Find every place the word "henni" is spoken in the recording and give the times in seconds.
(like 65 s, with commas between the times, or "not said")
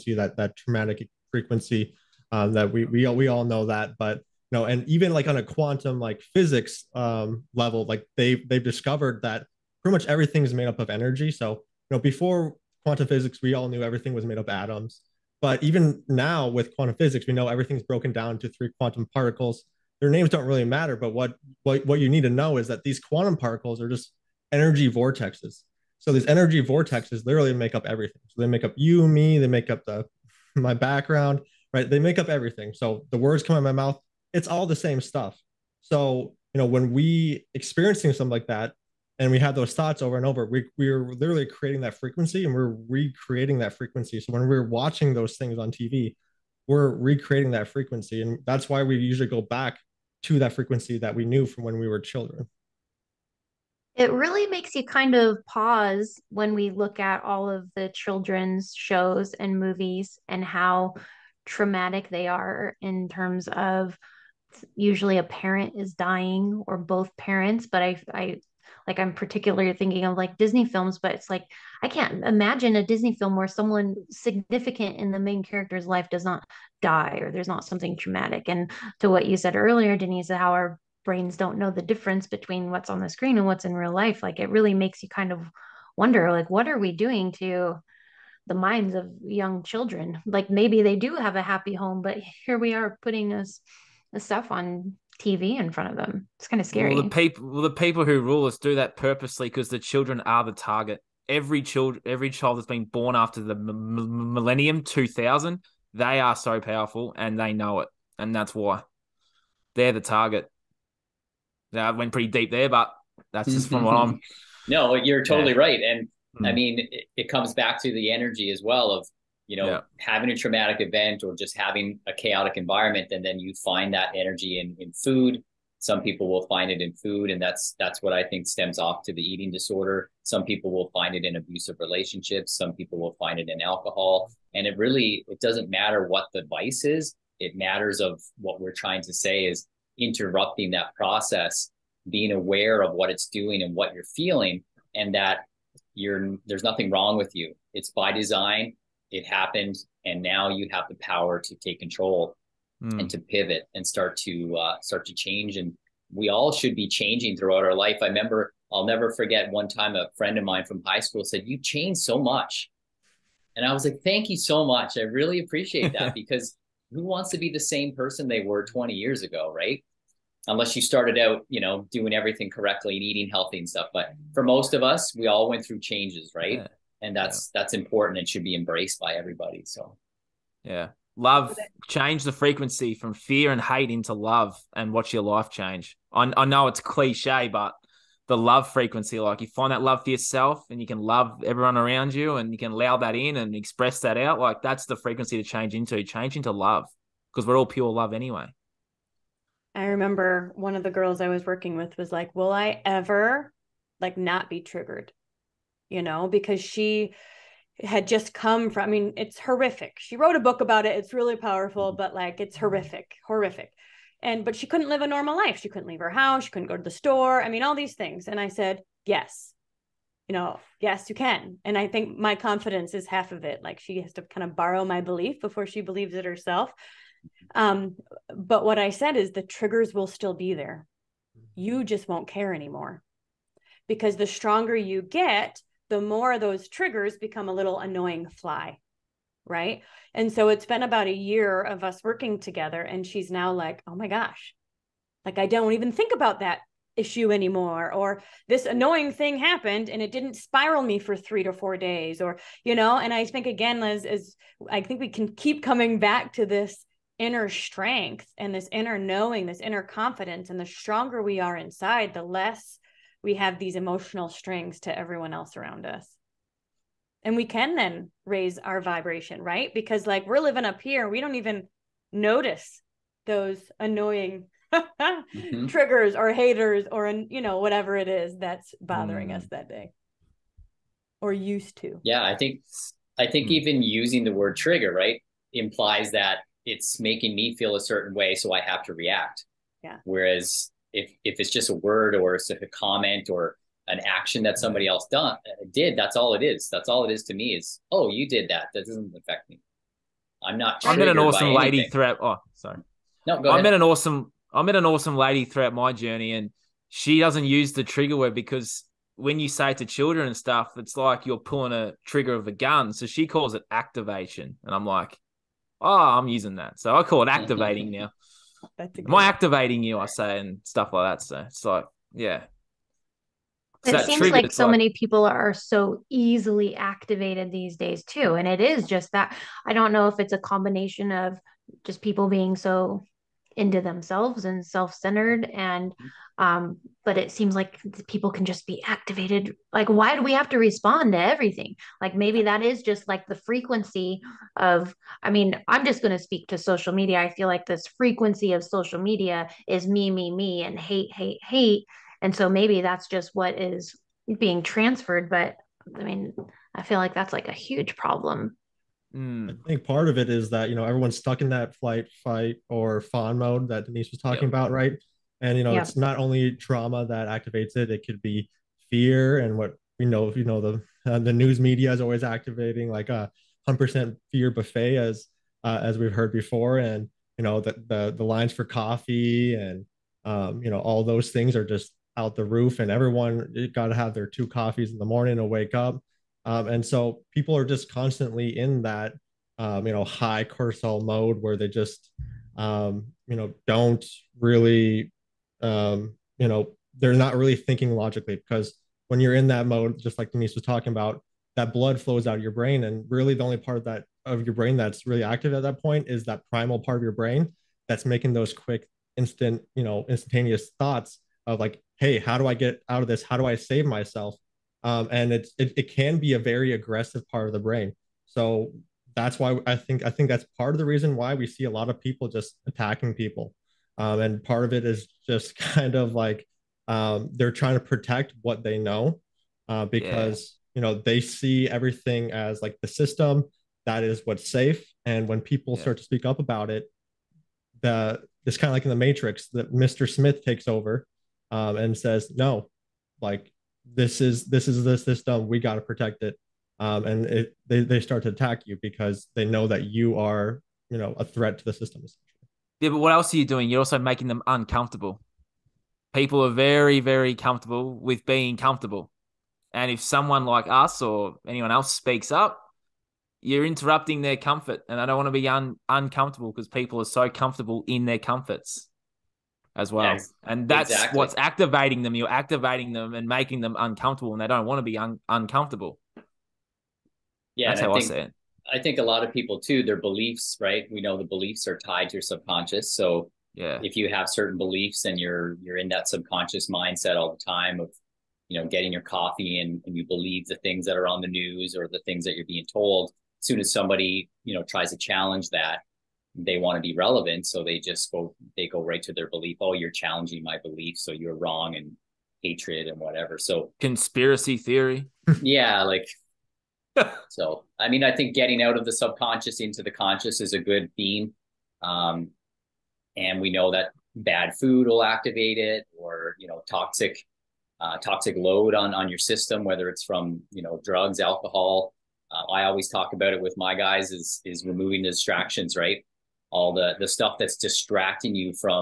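not said.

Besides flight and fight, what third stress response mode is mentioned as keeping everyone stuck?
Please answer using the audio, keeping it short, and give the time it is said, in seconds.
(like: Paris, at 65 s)
Fawn, at 363 s.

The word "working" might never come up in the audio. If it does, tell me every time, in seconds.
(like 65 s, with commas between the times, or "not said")
201 s, 242 s.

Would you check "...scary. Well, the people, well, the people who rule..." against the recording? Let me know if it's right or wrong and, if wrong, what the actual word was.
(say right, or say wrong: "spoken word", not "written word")
right.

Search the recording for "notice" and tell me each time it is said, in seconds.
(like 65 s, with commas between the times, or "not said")
272 s.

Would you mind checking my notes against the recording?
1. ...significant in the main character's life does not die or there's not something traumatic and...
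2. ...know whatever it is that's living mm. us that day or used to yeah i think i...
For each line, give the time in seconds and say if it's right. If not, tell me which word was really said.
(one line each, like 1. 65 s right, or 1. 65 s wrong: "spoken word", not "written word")
1. 74 s right
2. 277 s wrong: "bothering", not "living".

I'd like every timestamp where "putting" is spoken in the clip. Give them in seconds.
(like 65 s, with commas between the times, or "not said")
93 s.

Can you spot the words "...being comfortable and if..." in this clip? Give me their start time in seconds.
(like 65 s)
458 s.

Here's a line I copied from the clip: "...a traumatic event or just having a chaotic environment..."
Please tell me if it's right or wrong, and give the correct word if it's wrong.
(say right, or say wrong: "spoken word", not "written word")
right.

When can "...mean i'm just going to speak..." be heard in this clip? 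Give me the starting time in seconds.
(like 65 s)
345 s.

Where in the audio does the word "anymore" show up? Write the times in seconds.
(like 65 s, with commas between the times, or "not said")
232 s, 247 s.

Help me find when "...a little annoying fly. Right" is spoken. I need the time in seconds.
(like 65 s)
237 s.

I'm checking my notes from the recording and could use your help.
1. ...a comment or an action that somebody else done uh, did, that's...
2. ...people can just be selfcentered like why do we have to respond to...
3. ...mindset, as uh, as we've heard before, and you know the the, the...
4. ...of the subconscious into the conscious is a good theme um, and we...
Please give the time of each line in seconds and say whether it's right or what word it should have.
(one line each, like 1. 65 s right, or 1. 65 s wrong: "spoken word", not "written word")
1. 292 s right
2. 338 s wrong: "activated", not "selfcentered"
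3. 374 s wrong: "buffet", not "mindset"
4. 508 s right.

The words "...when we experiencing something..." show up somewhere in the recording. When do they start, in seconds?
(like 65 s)
36 s.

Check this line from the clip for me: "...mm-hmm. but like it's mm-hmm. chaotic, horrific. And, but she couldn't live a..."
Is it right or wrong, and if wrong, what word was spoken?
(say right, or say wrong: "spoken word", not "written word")
wrong: "horrific", not "chaotic".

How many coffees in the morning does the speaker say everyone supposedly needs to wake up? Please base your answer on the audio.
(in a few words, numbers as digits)
2.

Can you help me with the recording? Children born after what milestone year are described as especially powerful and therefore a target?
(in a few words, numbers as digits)
2000.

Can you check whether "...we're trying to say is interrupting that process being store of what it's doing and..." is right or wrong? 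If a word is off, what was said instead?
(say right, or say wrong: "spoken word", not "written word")
wrong: "aware", not "store".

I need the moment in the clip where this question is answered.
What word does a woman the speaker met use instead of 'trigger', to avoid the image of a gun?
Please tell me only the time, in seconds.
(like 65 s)
313 s.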